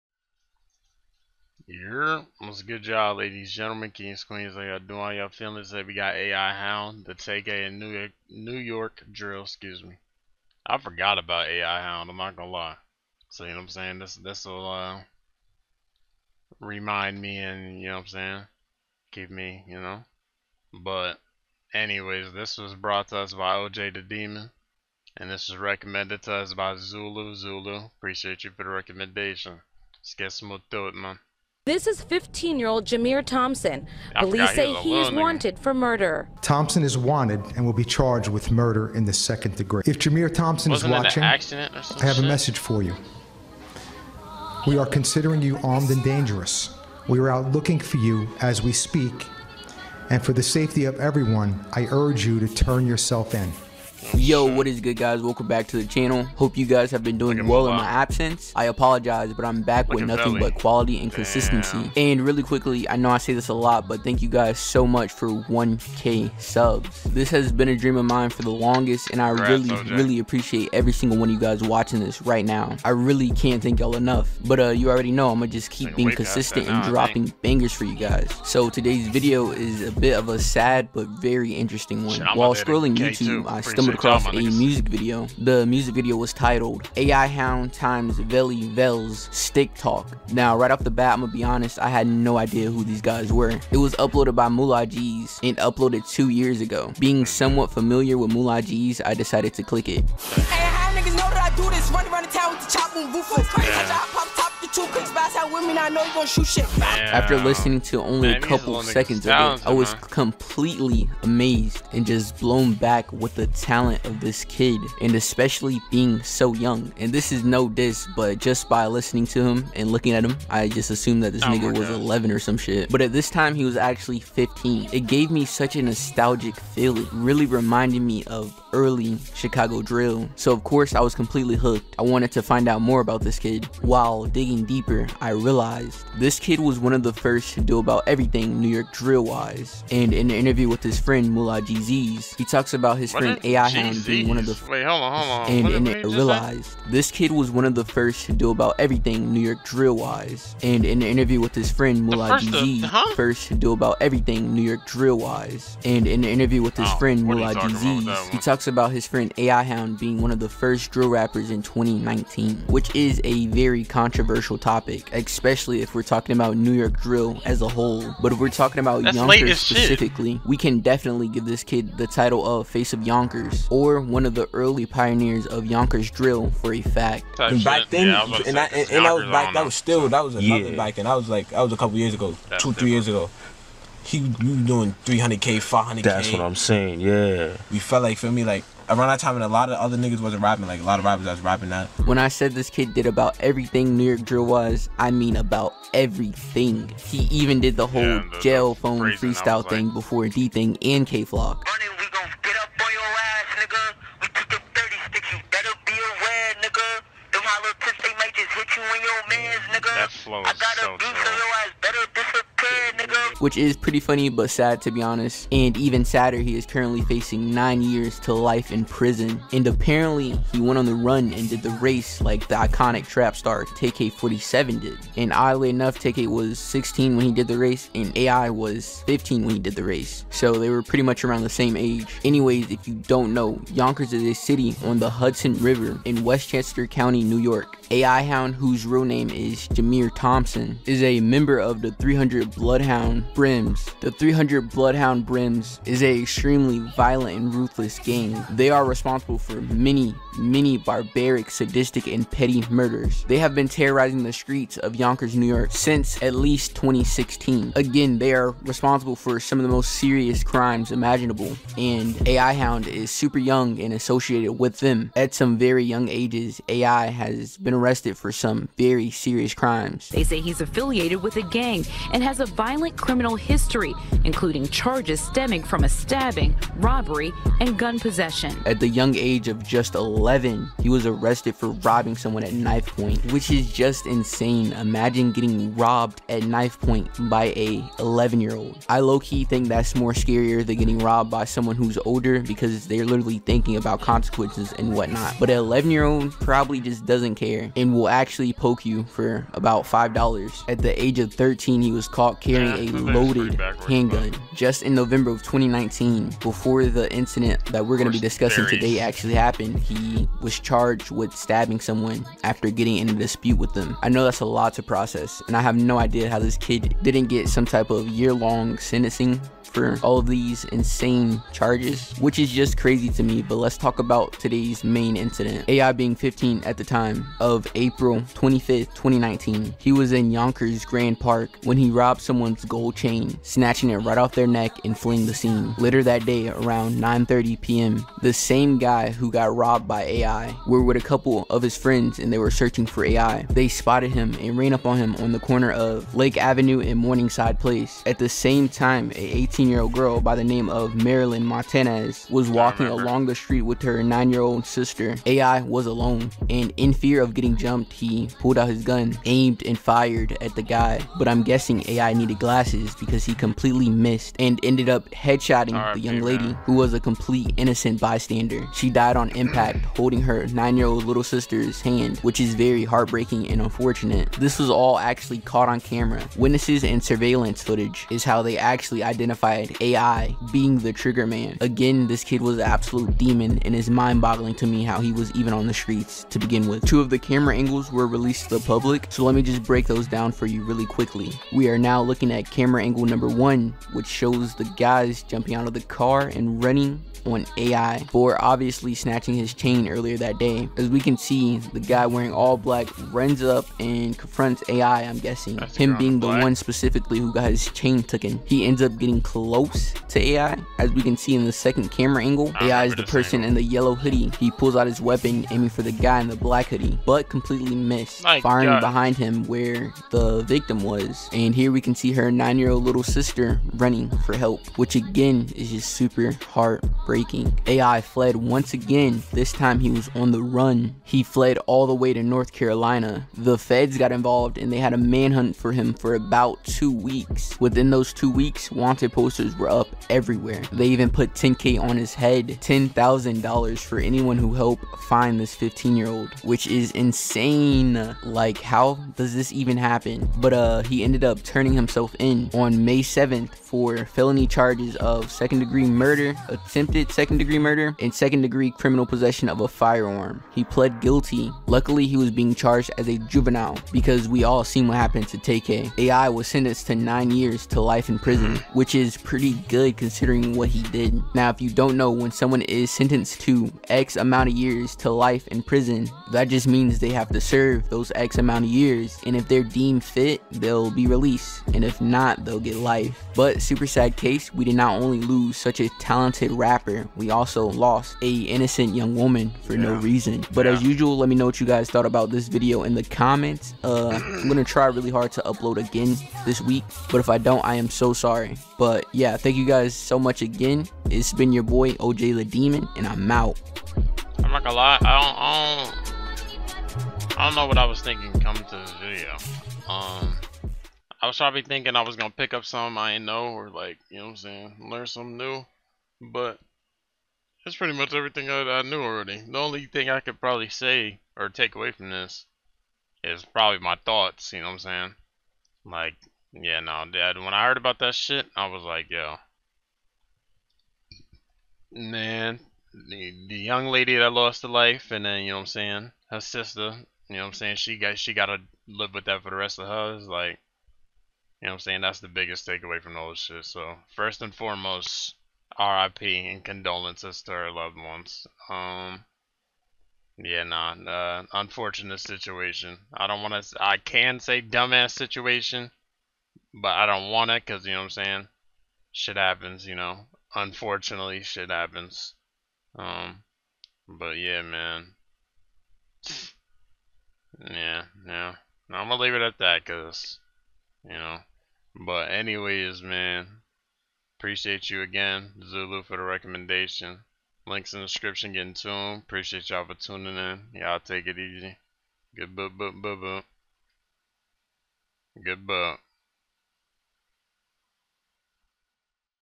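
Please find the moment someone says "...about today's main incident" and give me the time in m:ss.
5:23.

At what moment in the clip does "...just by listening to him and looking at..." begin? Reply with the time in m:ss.
1:58.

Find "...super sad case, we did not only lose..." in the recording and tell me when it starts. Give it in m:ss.
8:03.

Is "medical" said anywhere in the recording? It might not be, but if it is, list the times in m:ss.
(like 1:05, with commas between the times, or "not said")
not said.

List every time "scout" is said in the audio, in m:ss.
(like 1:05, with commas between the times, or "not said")
not said.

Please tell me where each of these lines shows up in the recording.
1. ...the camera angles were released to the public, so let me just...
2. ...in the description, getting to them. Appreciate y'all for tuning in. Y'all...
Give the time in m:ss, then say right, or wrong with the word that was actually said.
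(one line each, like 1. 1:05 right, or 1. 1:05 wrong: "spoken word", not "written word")
1. 6:27 right
2. 9:37 right.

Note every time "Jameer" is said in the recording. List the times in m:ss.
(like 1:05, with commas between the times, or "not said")
0:32, 0:39, 3:59.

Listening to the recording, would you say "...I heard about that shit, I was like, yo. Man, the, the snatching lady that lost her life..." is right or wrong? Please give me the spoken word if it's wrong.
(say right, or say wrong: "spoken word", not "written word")
wrong: "young", not "snatching".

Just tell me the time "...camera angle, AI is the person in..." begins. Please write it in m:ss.
6:51.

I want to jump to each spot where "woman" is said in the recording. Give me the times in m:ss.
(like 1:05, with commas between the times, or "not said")
8:09.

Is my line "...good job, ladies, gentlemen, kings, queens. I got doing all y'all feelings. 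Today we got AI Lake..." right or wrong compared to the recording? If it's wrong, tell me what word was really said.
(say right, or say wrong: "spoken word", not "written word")
wrong: "Hound", not "Lake".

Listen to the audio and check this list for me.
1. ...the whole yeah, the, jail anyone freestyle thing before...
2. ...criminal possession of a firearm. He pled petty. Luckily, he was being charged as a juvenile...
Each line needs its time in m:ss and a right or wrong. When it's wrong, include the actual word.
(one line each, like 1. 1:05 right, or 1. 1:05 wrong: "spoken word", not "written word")
1. 3:17 wrong: "phone", not "anyone"
2. 7:38 wrong: "guilty", not "petty".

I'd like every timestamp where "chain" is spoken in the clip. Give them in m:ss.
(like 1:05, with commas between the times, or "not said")
5:32, 6:39, 6:47.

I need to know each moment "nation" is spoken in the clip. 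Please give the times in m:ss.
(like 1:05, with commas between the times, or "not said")
not said.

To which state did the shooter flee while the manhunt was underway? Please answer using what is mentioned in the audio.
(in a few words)
North Carolina.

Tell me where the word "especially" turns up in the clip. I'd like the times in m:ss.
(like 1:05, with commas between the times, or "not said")
1:55, 2:45.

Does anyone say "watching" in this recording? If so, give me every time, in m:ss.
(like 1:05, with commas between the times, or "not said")
0:40, 1:11.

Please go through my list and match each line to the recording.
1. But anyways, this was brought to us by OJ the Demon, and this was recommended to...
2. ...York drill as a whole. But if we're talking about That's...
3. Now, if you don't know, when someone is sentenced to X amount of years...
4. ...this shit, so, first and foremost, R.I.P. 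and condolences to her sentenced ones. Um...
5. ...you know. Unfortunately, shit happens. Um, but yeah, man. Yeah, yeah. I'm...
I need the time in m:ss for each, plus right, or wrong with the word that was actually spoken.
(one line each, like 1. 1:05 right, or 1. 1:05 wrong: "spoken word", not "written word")
1. 0:20 right
2. 2:46 right
3. 7:51 right
4. 9:03 wrong: "loved", not "sentenced"
5. 9:19 right.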